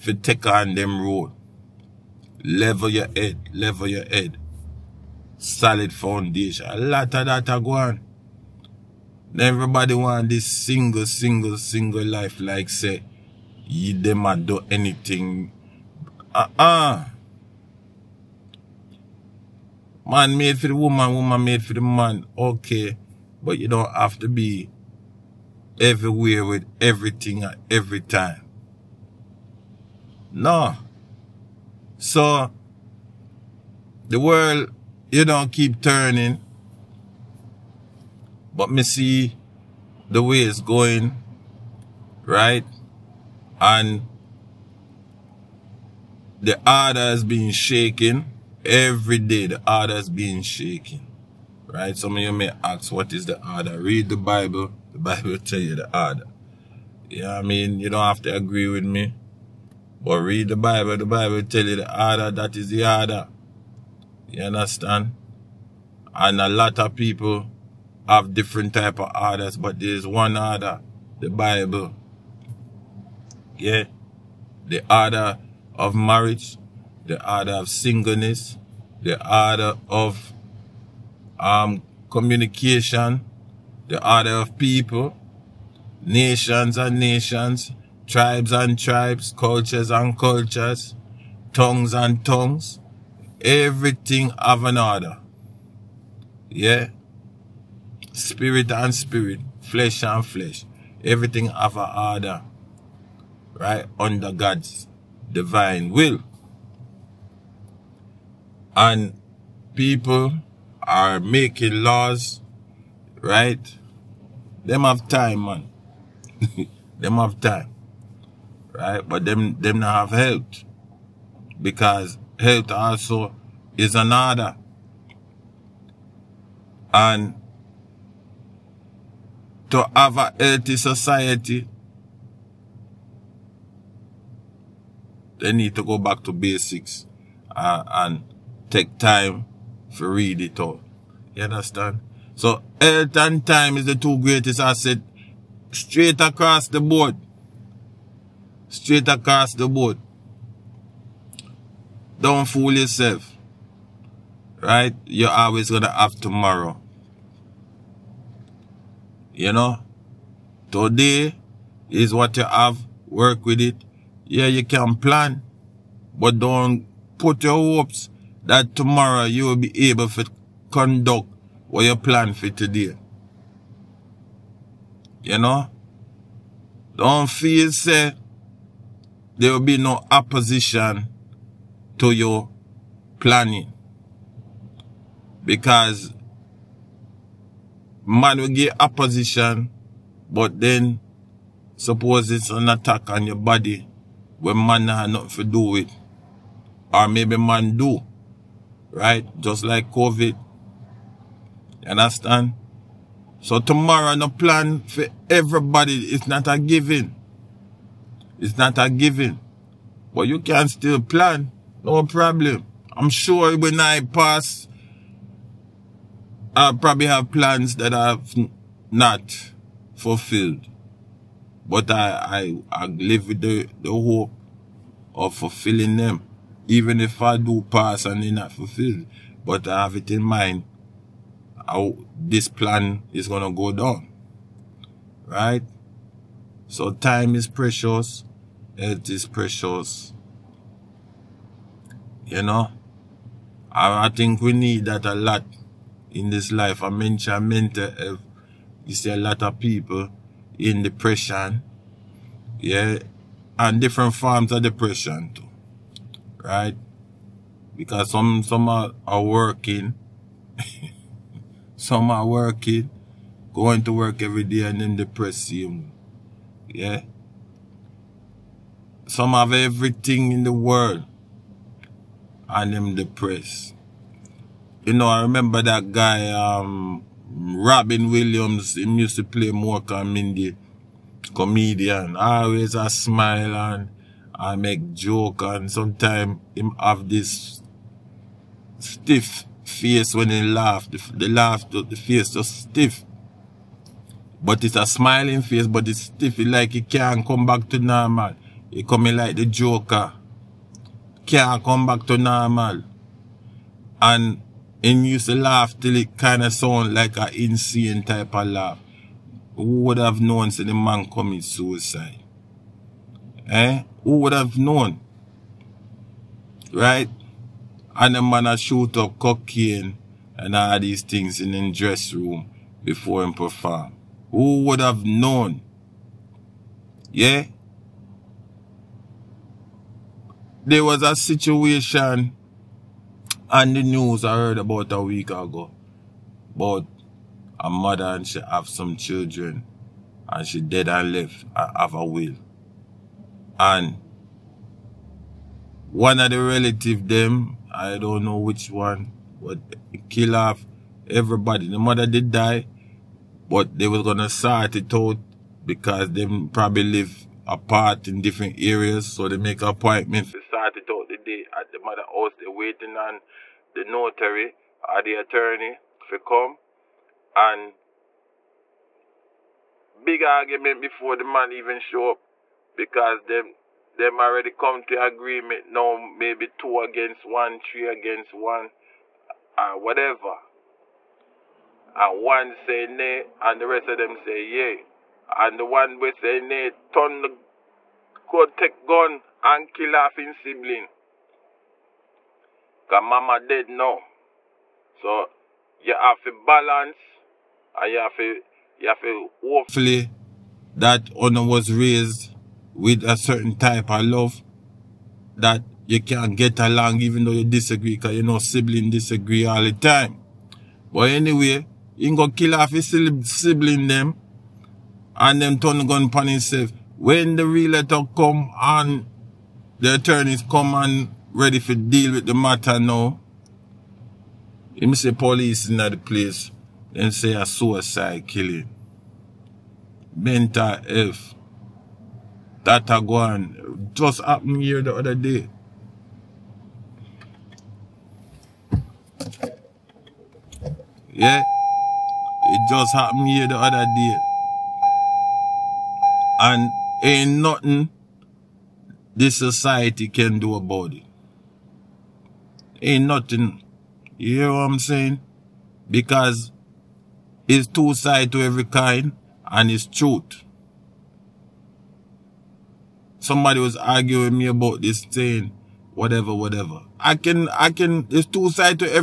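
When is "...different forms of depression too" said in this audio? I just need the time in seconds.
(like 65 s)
253 s.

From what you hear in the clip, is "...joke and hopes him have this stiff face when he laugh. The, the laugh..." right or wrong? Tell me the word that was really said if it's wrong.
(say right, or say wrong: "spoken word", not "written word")
wrong: "sometimes", not "hopes".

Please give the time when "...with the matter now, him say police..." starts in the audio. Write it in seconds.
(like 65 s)
422 s.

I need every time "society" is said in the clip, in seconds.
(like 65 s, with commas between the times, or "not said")
130 s, 449 s.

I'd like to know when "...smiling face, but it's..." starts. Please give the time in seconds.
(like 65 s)
294 s.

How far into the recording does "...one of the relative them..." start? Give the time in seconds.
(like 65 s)
345 s.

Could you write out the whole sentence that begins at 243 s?
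I, I think we need that a lot in this life.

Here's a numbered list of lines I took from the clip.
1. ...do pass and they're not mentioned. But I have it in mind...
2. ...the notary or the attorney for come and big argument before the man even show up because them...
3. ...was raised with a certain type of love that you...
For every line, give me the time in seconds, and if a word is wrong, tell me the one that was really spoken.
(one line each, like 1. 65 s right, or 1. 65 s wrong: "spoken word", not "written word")
1. 227 s wrong: "fulfilled", not "mentioned"
2. 363 s right
3. 401 s right.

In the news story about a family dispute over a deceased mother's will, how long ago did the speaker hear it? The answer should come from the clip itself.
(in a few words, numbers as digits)
A week ago.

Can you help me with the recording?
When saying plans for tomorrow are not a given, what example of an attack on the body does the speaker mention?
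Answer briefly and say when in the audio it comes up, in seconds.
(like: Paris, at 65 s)
COVID, at 199 s.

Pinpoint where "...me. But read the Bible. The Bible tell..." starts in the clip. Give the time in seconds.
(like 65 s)
58 s.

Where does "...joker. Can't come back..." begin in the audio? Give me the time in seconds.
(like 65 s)
299 s.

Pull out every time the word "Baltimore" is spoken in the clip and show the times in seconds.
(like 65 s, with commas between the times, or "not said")
not said.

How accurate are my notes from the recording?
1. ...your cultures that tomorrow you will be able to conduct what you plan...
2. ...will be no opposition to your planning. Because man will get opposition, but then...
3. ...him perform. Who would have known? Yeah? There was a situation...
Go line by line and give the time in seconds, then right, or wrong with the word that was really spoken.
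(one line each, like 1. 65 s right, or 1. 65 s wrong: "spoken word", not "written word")
1. 167 s wrong: "hopes", not "cultures"
2. 179 s right
3. 323 s right.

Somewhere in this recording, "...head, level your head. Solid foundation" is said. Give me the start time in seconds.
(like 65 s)
3 s.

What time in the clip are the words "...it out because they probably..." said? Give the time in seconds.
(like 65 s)
354 s.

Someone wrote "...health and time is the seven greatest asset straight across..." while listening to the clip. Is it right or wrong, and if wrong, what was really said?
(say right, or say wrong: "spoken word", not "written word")
wrong: "two", not "seven".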